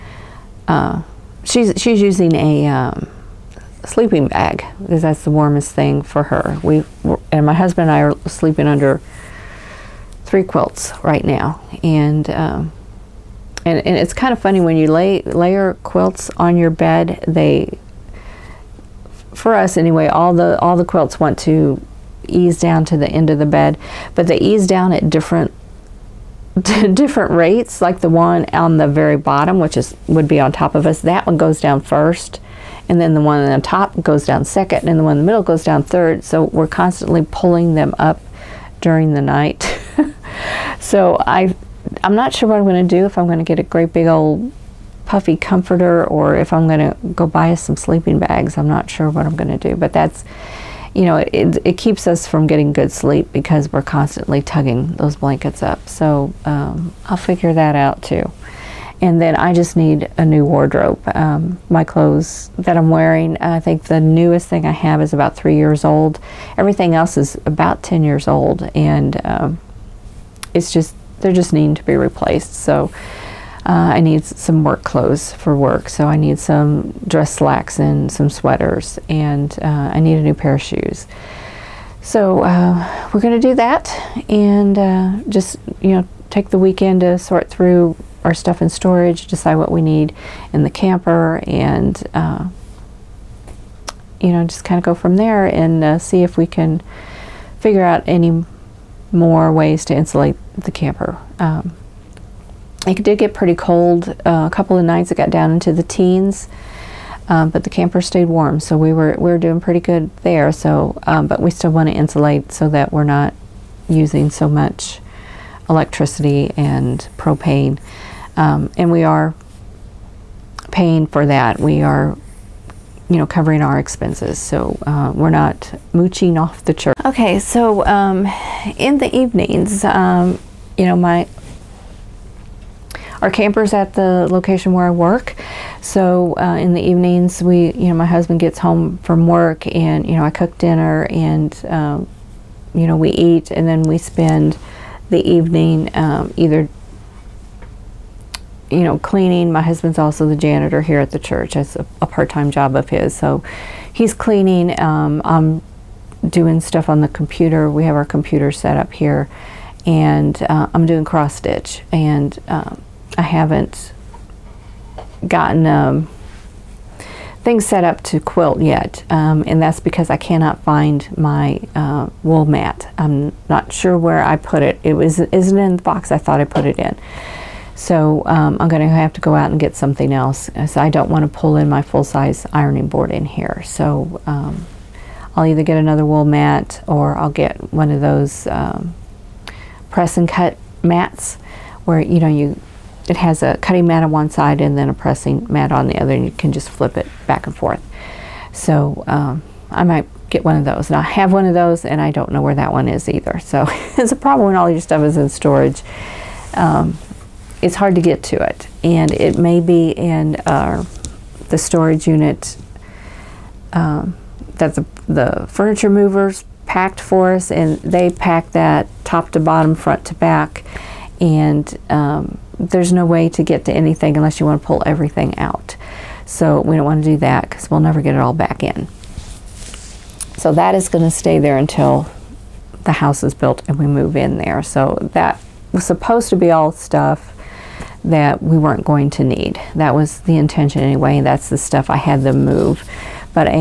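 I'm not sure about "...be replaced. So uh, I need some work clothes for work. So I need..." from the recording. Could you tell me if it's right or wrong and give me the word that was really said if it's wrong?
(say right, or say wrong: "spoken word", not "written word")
right.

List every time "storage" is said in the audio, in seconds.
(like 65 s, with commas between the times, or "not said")
88 s, 205 s, 211 s.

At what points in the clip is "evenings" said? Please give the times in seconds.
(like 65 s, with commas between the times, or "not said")
129 s, 136 s, 145 s.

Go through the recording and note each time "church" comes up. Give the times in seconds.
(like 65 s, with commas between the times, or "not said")
126 s, 151 s.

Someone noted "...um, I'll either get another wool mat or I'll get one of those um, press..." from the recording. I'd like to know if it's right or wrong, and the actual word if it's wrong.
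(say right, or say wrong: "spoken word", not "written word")
right.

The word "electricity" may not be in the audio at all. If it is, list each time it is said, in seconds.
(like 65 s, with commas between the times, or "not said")
115 s.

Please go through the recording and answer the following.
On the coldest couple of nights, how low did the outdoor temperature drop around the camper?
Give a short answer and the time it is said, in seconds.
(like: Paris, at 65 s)
the teens, at 105 s.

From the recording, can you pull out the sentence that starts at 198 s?
So um, I might get one of those.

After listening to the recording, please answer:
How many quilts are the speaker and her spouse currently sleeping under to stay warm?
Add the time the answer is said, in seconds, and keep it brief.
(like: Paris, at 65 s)
3, at 10 s.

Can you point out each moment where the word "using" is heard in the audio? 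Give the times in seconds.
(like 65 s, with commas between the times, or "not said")
2 s, 113 s.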